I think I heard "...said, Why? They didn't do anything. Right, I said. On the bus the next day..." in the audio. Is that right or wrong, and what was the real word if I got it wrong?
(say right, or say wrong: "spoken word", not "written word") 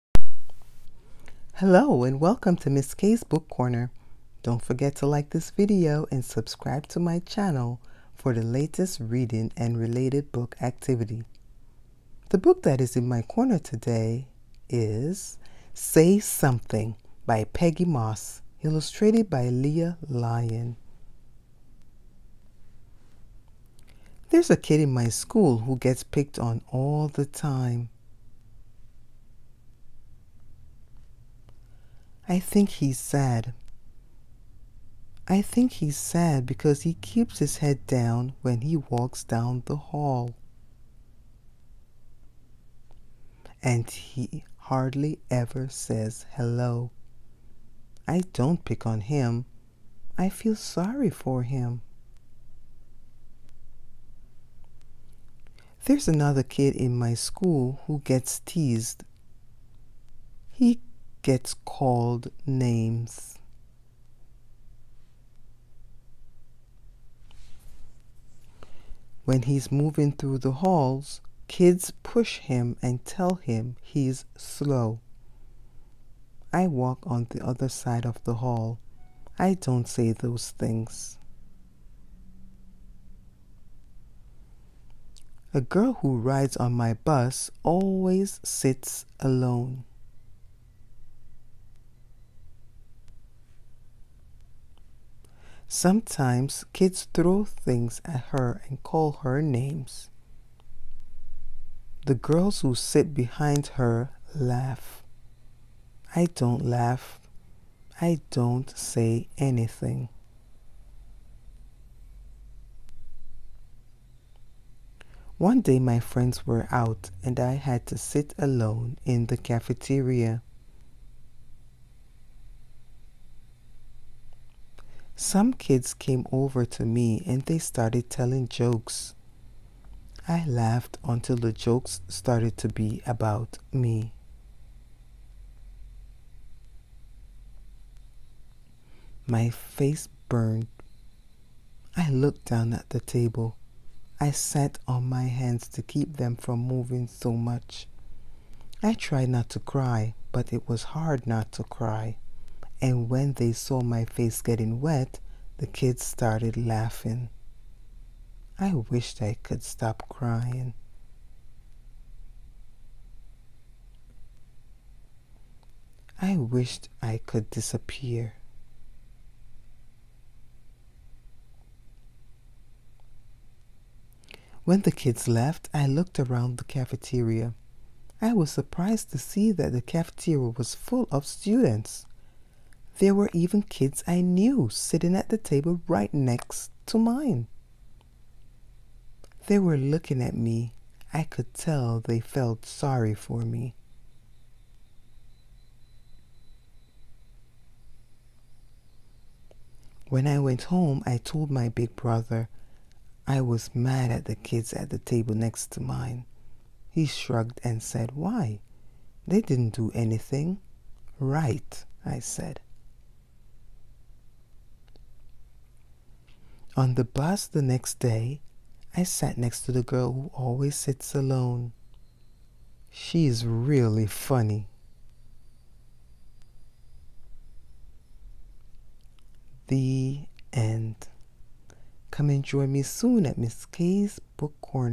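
right.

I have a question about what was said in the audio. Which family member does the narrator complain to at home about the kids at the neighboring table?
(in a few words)
big brother.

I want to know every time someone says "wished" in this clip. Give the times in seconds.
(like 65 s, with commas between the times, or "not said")
158 s, 166 s.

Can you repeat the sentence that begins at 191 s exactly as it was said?
I could tell they felt sorry for me.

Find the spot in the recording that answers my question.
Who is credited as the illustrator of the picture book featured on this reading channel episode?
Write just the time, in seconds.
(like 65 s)
19 s.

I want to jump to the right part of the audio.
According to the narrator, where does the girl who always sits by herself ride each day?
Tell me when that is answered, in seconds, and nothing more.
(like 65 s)
86 s.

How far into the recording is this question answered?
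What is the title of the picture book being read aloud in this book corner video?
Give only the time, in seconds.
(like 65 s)
15 s.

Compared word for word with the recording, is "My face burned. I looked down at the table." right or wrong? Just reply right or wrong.
right.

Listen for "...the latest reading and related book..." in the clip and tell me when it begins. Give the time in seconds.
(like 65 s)
8 s.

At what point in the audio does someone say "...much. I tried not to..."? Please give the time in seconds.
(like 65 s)
147 s.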